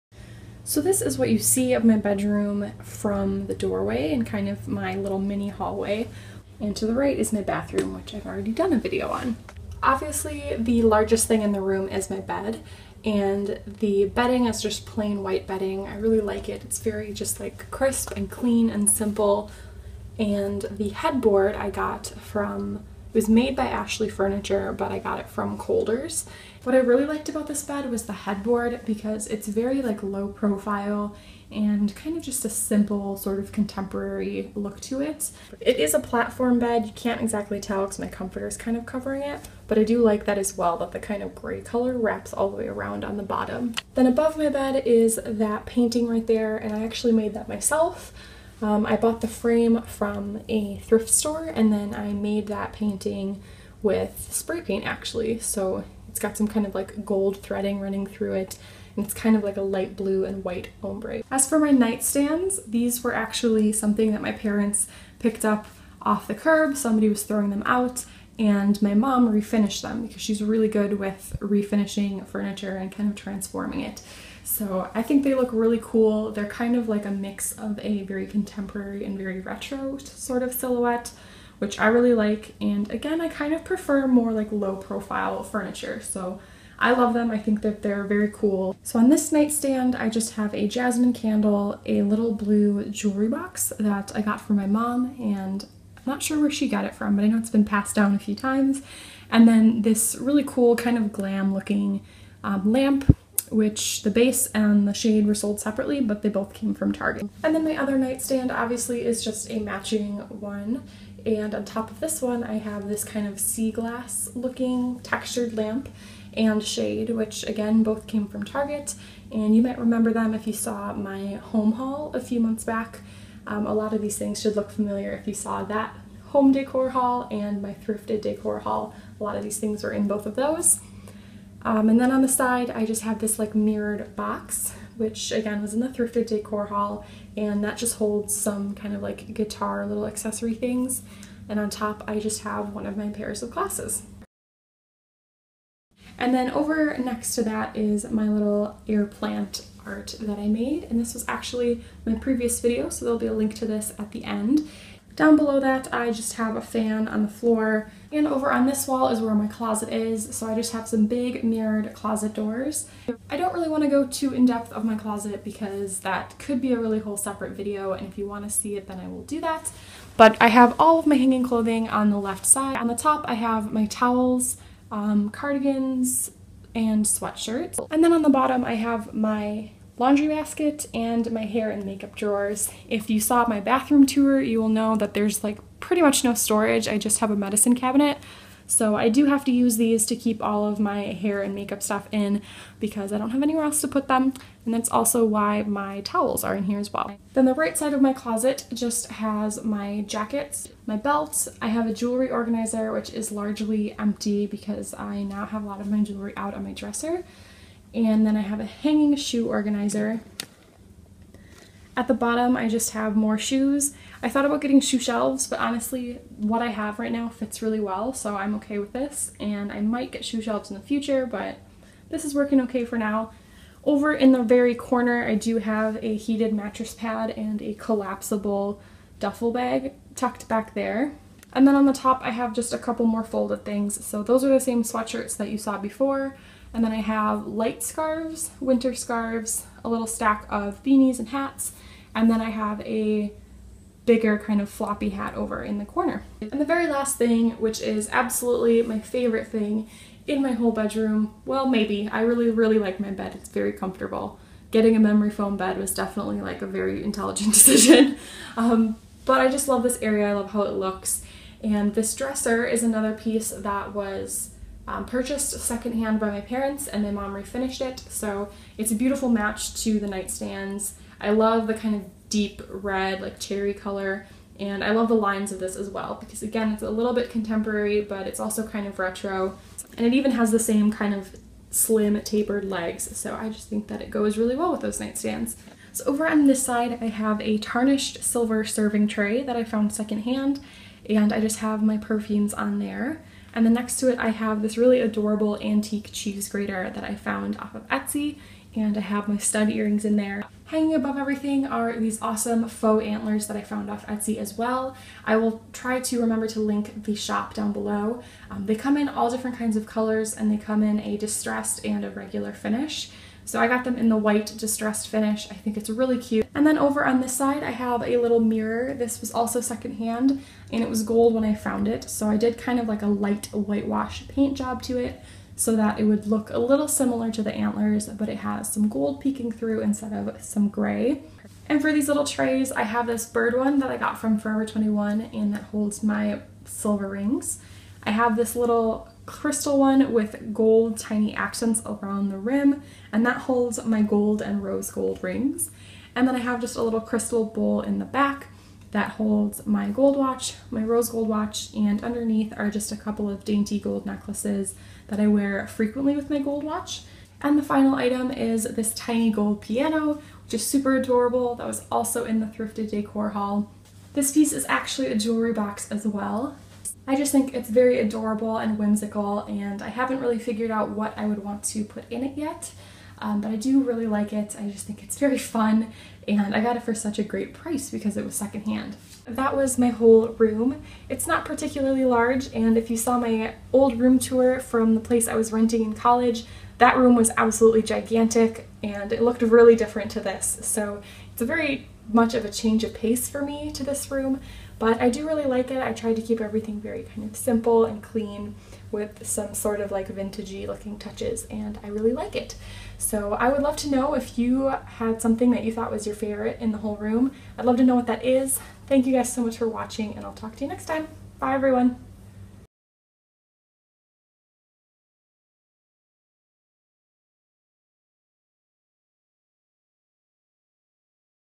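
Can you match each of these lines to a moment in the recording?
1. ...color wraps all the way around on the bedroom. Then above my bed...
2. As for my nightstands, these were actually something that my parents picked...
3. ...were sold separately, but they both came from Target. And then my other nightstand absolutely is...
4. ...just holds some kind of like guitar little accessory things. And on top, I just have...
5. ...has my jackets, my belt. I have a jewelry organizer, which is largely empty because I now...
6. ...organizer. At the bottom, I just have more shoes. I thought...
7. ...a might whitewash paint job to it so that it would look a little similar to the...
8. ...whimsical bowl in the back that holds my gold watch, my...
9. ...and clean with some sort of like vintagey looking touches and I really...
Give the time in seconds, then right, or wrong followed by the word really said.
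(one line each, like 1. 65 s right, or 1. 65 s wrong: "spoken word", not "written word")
1. 41 s wrong: "bottom", not "bedroom"
2. 61 s right
3. 105 s wrong: "obviously", not "absolutely"
4. 137 s right
5. 199 s right
6. 209 s right
7. 323 s wrong: "light", not "might"
8. 347 s wrong: "crystal", not "whimsical"
9. 397 s right.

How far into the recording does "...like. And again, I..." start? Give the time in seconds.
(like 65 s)
82 s.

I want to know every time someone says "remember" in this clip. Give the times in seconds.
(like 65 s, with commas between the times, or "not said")
119 s, 306 s.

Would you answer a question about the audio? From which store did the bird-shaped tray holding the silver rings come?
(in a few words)
Forever 21.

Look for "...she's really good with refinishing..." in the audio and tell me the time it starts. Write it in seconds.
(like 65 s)
70 s.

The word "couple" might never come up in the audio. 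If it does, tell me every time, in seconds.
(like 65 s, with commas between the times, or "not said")
232 s, 352 s.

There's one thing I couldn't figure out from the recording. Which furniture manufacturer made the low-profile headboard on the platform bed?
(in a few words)
Ashley Furniture.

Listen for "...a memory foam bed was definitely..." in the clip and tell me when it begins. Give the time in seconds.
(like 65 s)
254 s.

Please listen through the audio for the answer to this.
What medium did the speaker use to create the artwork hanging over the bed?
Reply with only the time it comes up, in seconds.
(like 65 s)
54 s.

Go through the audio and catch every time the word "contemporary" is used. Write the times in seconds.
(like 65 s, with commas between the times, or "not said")
33 s, 78 s, 277 s.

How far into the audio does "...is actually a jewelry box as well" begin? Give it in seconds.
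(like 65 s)
364 s.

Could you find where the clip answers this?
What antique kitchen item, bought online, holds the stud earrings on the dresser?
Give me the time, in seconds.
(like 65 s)
296 s.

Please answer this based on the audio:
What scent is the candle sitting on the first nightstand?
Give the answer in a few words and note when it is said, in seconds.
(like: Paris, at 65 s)
Jasmine, at 90 s.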